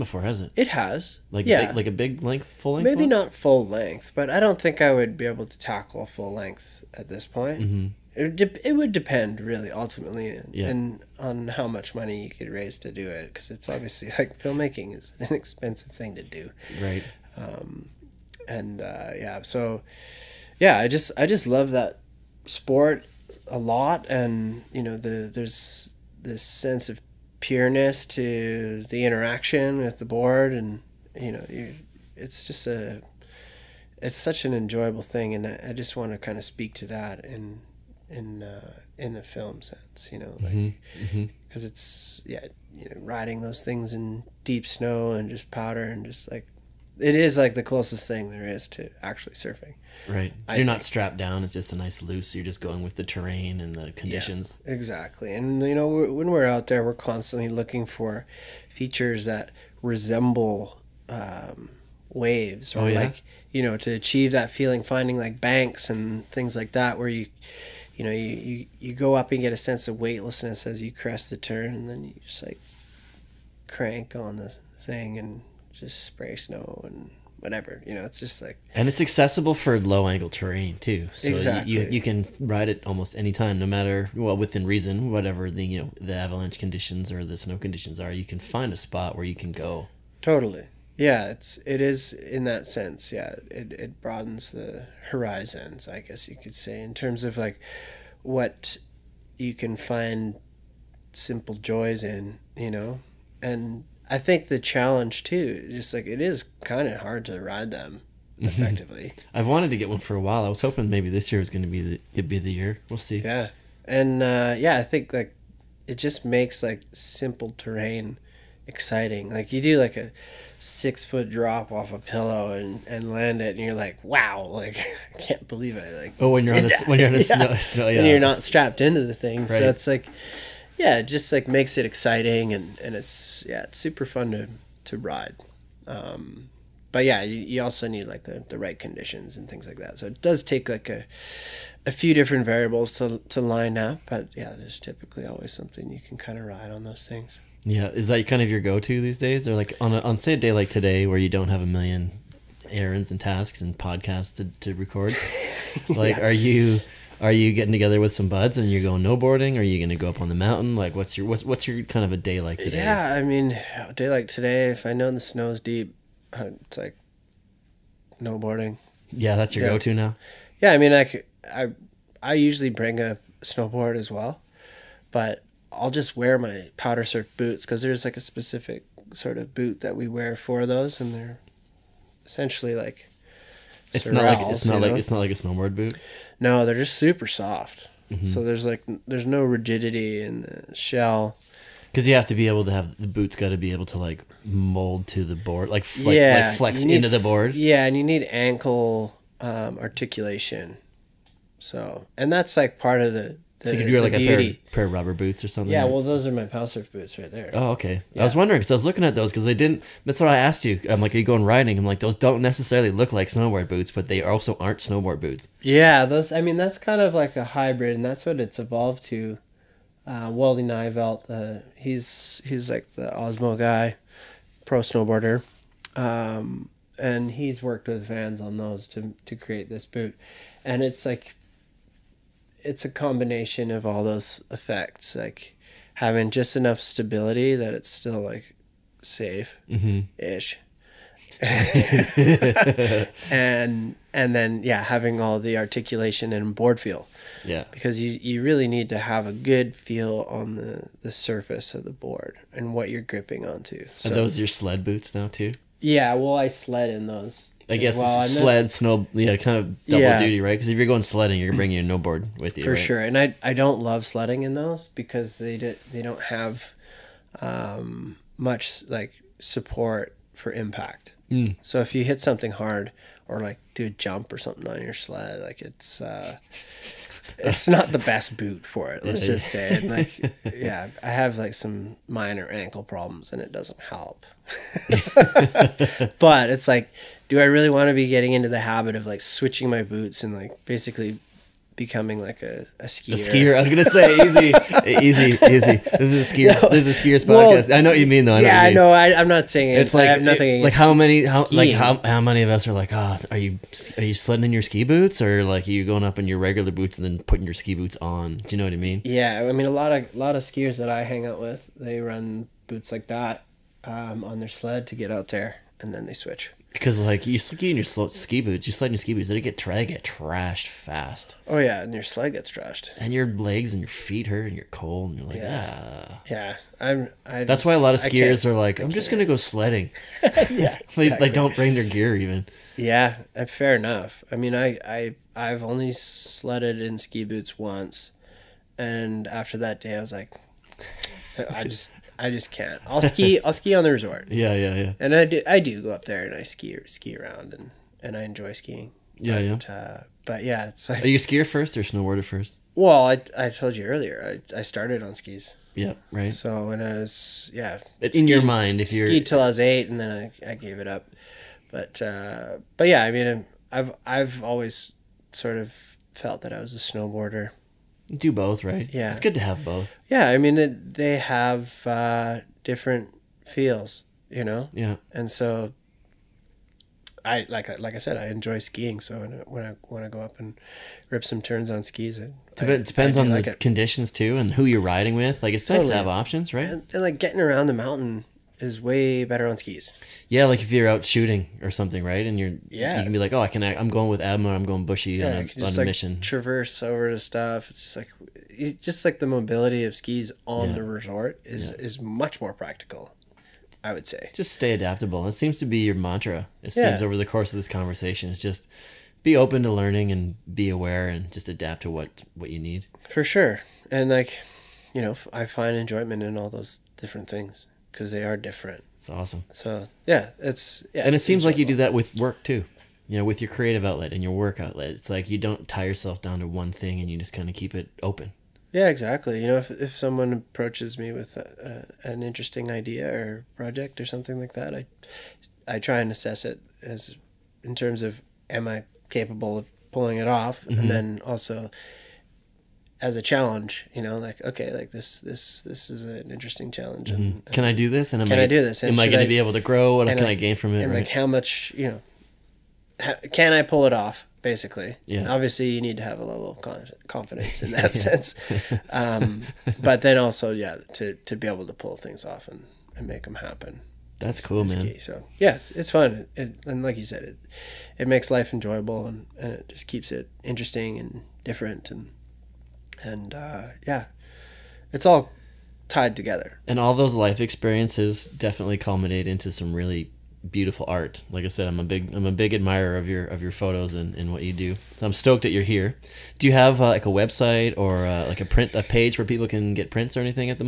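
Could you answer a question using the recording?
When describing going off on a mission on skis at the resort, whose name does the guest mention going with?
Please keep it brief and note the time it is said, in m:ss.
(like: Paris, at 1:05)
Emma, at 6:34.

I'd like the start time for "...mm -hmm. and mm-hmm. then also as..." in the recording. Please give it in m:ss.
7:20.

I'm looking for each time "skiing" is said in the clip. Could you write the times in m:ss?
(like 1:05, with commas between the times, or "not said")
5:48, 6:18.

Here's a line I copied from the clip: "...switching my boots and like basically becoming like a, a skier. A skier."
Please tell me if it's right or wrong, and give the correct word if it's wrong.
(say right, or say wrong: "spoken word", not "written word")
right.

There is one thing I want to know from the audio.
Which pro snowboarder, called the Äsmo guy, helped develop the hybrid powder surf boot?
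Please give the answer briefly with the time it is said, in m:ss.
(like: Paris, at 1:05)
Wolle Nyvelt, at 3:40.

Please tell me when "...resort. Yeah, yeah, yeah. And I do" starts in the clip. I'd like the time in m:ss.
5:43.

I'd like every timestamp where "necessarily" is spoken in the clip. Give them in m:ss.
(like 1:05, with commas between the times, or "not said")
3:32.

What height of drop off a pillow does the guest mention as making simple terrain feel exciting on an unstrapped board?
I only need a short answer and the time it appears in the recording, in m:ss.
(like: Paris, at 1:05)
6 foot, at 2:00.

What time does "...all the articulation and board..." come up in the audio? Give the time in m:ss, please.
4:05.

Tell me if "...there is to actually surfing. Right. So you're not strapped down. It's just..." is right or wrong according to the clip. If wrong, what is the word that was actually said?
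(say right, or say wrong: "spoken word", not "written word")
right.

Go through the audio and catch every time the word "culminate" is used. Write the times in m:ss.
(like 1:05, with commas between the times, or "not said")
7:58.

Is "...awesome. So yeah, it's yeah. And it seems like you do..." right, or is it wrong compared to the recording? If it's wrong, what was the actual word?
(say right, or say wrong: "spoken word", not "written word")
right.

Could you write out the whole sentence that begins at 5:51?
Are you a skier first or snowboarder first?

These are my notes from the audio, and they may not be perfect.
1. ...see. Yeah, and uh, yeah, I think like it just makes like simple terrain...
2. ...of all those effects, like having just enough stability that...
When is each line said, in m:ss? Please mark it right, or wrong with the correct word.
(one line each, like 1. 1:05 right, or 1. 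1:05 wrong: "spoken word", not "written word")
1. 1:52 right
2. 3:53 right.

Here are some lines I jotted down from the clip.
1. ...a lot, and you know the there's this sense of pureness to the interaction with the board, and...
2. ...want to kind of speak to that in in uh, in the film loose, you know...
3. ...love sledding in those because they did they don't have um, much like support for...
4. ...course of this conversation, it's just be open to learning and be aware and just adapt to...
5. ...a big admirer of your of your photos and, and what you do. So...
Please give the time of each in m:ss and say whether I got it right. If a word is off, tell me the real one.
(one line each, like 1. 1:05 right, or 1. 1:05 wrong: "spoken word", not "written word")
1. 0:23 right
2. 0:35 wrong: "sense", not "loose"
3. 4:23 right
4. 6:47 right
5. 8:02 right.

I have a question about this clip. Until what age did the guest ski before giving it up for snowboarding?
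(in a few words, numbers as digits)
8.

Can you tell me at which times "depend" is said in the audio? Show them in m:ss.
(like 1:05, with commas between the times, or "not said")
0:08, 6:22.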